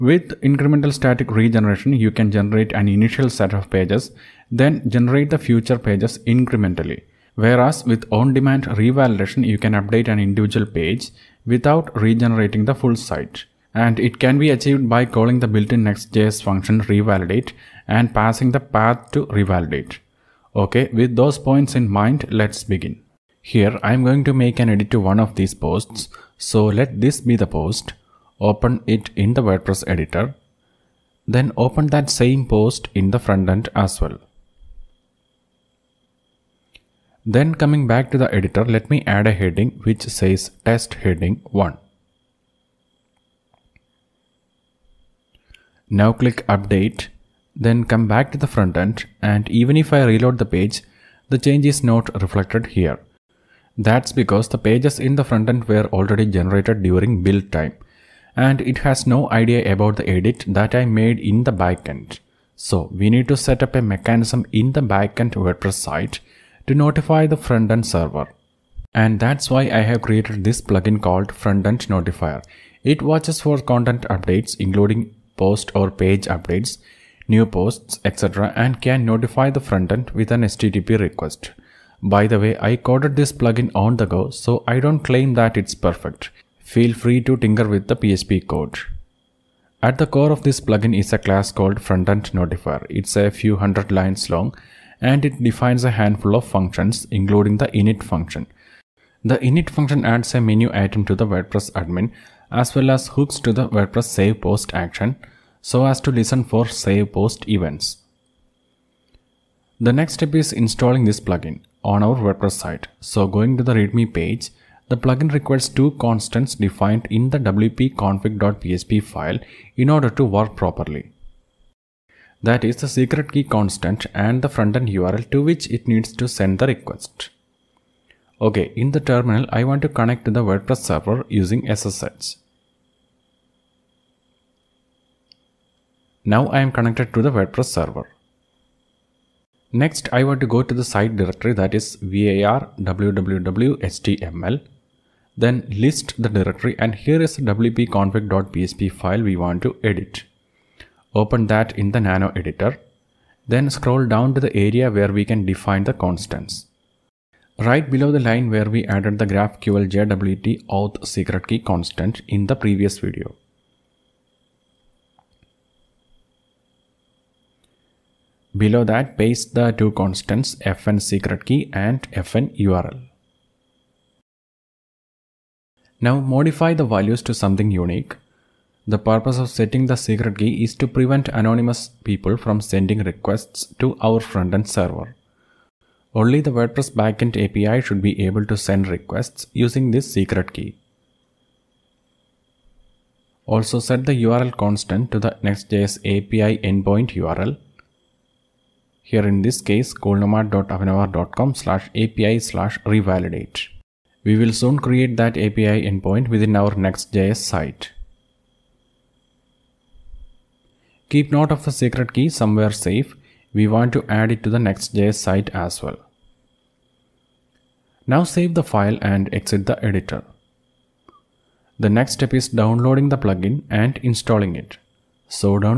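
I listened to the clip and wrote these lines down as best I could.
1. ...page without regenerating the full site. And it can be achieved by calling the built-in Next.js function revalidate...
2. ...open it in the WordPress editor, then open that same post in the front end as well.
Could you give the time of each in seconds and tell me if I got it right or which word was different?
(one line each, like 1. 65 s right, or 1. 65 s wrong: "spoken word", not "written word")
1. 10 s right
2. 28 s right.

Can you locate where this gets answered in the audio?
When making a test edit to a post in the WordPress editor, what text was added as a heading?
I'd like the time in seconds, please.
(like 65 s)
40 s.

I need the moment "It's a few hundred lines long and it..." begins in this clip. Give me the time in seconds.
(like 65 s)
92 s.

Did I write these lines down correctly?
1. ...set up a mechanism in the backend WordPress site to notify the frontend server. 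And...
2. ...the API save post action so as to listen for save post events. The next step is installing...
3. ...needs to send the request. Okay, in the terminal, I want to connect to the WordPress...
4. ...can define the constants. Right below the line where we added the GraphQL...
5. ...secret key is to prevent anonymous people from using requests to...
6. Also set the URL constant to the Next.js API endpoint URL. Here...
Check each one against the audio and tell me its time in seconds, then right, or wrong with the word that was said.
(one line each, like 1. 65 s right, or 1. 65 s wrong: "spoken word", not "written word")
1. 63 s right
2. 103 s wrong: "WordPress", not "API"
3. 125 s right
4. 155 s right
5. 179 s wrong: "sending", not "using"
6. 193 s right.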